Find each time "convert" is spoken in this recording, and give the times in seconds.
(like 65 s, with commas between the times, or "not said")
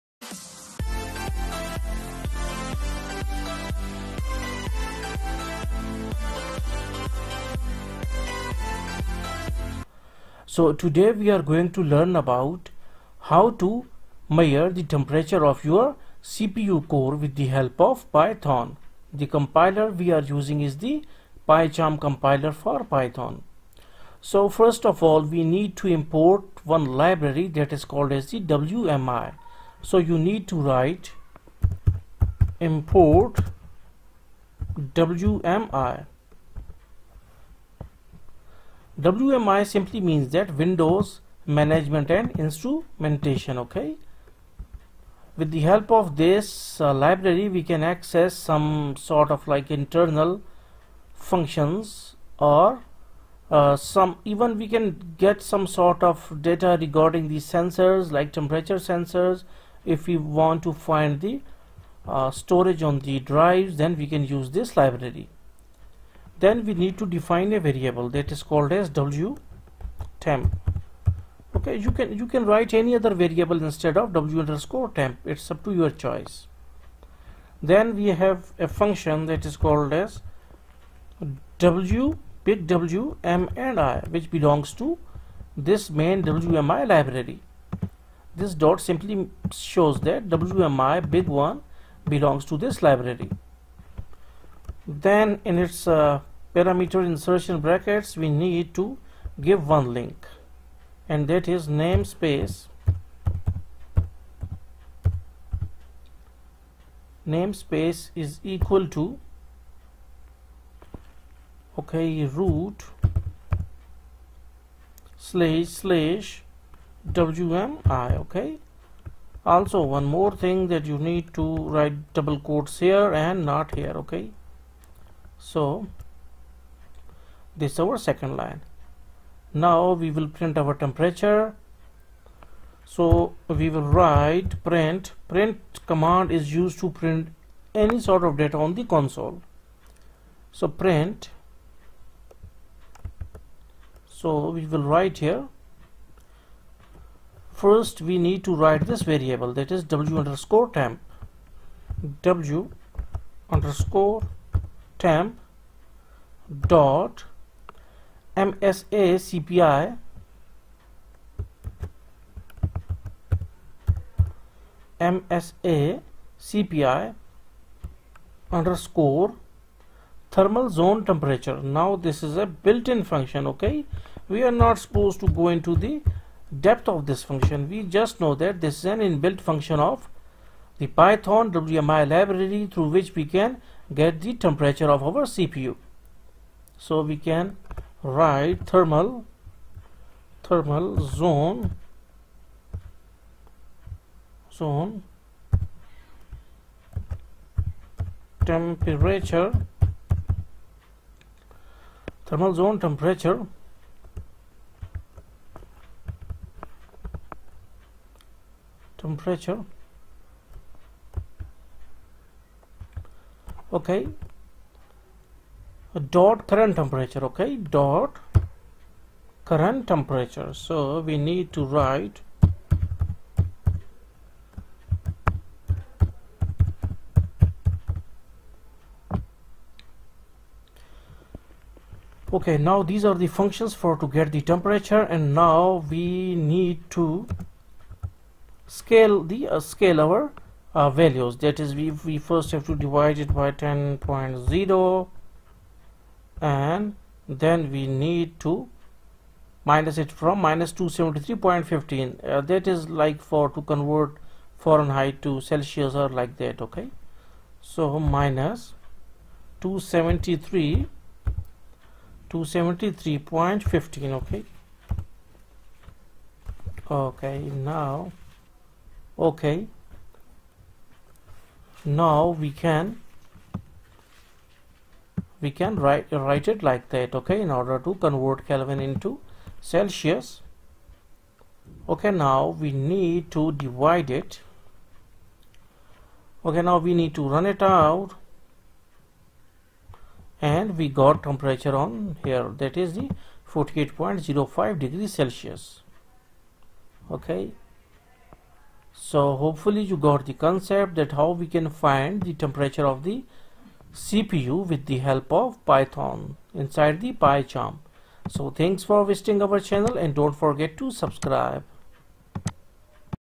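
253 s, 277 s.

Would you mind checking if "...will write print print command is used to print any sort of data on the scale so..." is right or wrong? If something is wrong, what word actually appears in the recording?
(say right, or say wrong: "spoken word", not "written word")
wrong: "console", not "scale".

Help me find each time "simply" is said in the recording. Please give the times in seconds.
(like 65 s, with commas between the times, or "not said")
39 s, 88 s.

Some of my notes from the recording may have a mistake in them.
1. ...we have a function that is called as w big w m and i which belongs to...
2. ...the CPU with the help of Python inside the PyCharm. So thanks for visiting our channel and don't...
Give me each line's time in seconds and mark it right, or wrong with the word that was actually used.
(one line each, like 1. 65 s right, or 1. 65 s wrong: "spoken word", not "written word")
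1. 78 s right
2. 303 s right.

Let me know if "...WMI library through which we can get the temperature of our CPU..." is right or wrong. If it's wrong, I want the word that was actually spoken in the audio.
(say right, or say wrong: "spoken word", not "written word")
right.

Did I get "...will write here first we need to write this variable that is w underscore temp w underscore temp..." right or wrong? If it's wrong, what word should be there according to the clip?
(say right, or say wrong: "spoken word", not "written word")
right.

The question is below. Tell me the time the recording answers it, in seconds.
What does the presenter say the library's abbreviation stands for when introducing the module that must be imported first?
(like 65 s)
40 s.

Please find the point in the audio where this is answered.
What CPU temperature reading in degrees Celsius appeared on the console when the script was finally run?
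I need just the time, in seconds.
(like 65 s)
293 s.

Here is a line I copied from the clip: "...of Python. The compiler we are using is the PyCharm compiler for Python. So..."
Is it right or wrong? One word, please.
right.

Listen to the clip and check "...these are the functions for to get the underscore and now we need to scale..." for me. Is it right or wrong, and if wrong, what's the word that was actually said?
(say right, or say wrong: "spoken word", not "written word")
wrong: "temperature", not "underscore".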